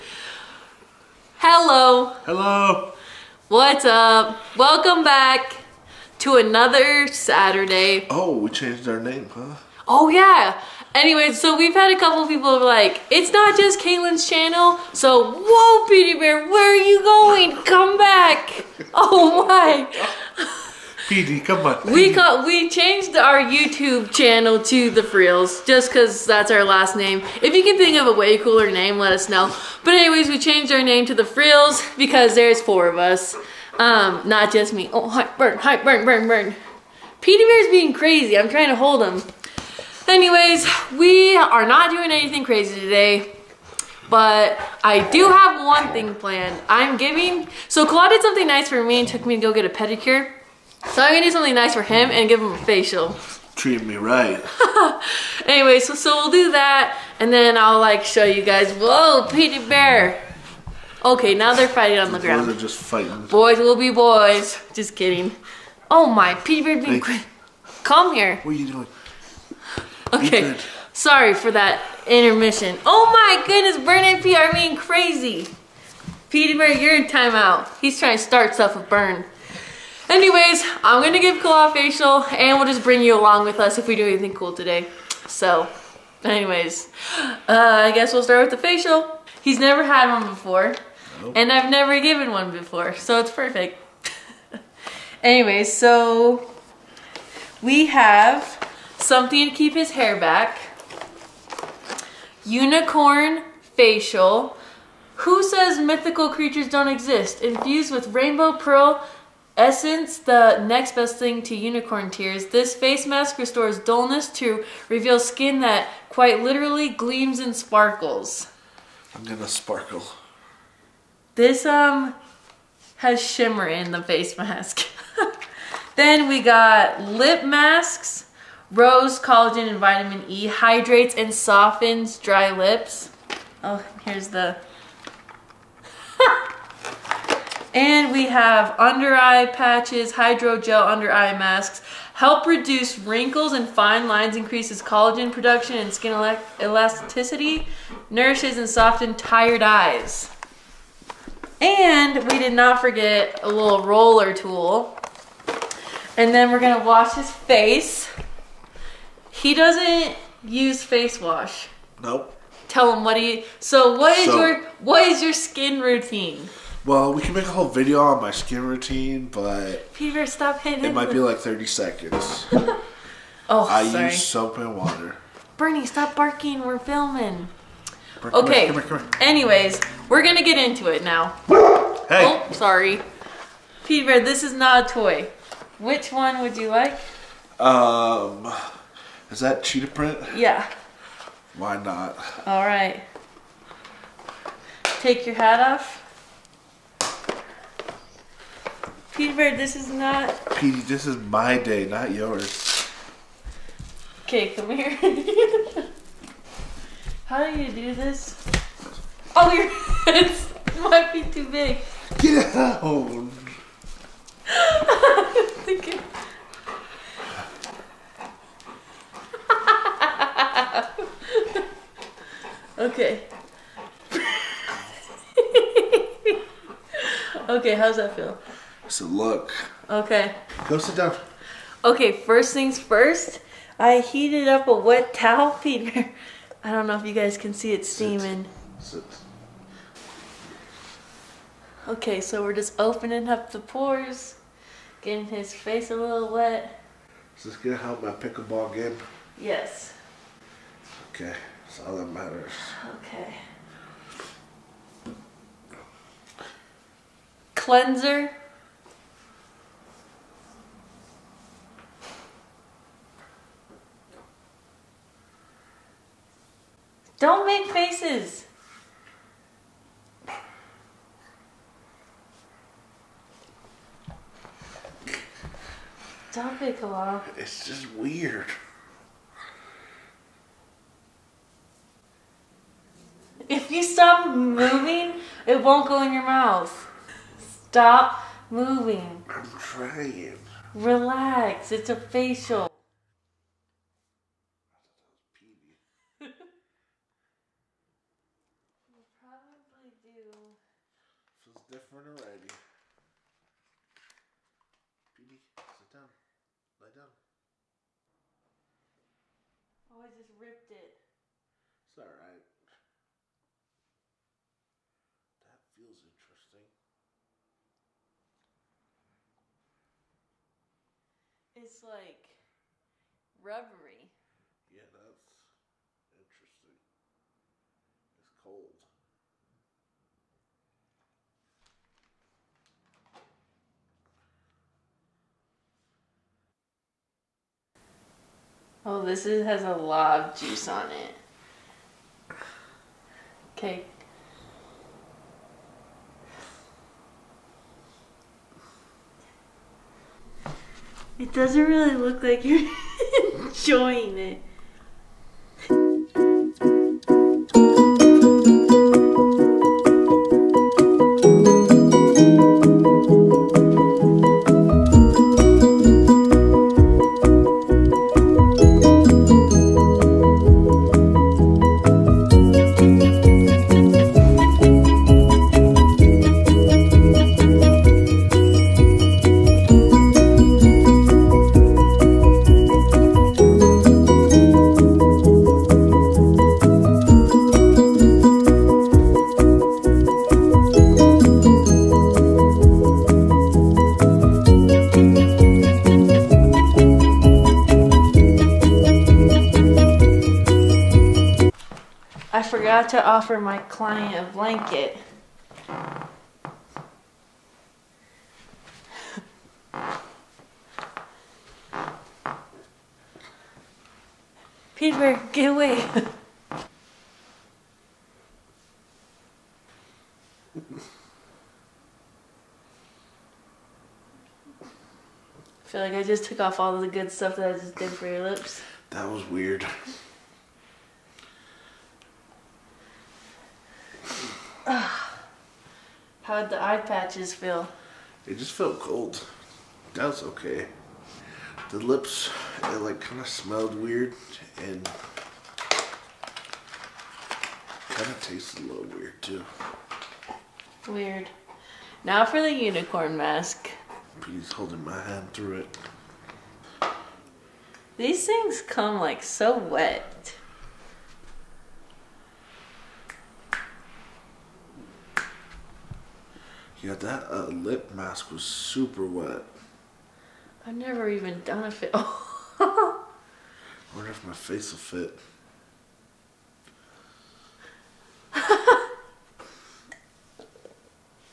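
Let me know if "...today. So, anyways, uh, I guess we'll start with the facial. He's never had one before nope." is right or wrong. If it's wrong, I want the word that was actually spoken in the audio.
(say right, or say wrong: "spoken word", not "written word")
right.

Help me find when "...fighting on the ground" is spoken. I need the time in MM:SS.
01:01.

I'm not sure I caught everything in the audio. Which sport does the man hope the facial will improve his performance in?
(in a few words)
Pickleball.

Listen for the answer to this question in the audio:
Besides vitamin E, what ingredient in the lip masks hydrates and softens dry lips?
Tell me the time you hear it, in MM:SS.
02:08.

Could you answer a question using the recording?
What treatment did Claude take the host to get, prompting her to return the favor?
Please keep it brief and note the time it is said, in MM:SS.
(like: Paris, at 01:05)
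A pedicure, at 00:49.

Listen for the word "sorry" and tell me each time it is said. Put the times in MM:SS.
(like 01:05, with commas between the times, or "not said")
01:10, 02:53, 03:02.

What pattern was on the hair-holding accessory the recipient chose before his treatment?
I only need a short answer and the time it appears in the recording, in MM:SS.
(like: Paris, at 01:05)
Cheetah print, at 03:09.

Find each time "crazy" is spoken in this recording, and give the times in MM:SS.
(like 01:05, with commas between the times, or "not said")
00:37, 00:42, 01:14.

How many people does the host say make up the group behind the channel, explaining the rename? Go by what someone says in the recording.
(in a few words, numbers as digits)
4.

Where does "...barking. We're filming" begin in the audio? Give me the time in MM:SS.
02:56.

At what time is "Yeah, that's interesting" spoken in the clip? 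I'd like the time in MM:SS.
05:24.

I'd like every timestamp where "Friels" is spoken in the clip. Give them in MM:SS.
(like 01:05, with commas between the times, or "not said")
00:25, 00:31.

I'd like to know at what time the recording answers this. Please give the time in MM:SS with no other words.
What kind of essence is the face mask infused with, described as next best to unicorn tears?
01:48.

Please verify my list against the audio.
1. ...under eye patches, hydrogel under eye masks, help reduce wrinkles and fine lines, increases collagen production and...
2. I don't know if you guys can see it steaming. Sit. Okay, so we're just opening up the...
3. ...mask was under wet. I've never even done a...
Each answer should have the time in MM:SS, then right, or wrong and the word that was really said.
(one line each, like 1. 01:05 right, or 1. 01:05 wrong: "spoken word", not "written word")
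1. 02:18 right
2. 03:56 right
3. 07:47 wrong: "super", not "under".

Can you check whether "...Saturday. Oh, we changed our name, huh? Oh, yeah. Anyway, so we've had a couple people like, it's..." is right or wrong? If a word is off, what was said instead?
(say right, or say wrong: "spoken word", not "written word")
right.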